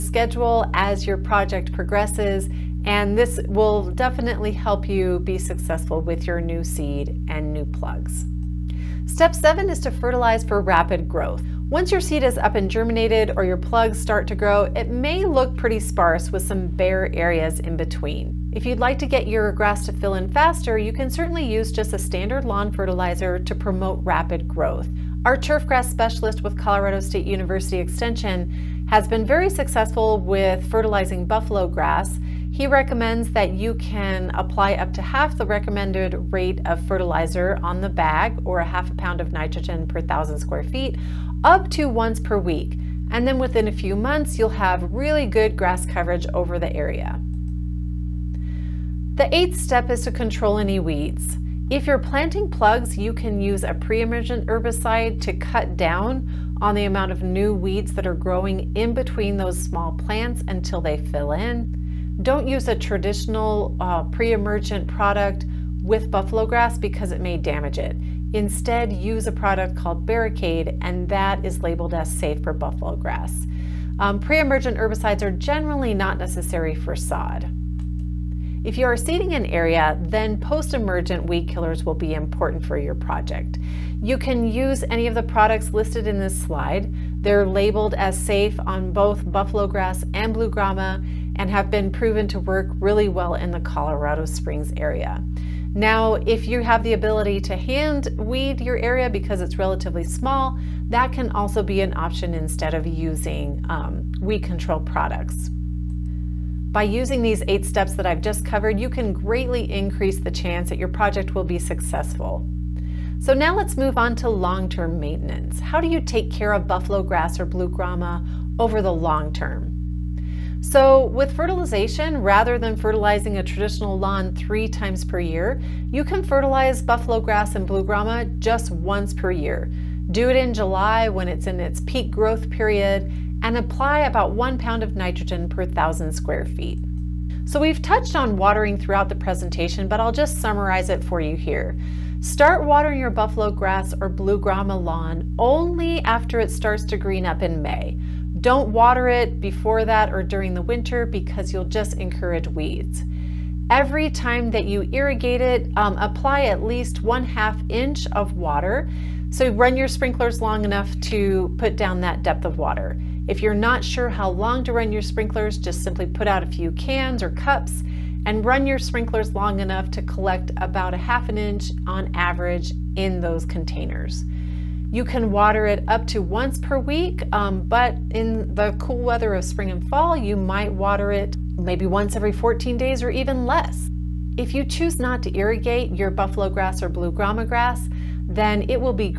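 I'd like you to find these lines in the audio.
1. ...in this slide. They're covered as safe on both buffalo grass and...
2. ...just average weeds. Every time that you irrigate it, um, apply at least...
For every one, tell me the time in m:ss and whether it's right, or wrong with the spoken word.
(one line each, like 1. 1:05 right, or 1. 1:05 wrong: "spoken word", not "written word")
1. 1:26 wrong: "labeled", not "covered"
2. 2:31 wrong: "encourage", not "average".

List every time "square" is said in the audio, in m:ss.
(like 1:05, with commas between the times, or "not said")
0:40, 2:16.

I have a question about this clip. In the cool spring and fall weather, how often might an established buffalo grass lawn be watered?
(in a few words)
once every 14 days.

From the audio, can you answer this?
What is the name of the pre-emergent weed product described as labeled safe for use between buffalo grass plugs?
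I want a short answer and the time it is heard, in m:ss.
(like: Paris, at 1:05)
Barricade, at 1:10.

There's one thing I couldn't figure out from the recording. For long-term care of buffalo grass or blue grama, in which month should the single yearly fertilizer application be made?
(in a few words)
July.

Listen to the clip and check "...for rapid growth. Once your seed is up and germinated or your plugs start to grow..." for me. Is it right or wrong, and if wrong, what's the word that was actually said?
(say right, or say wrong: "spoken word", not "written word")
right.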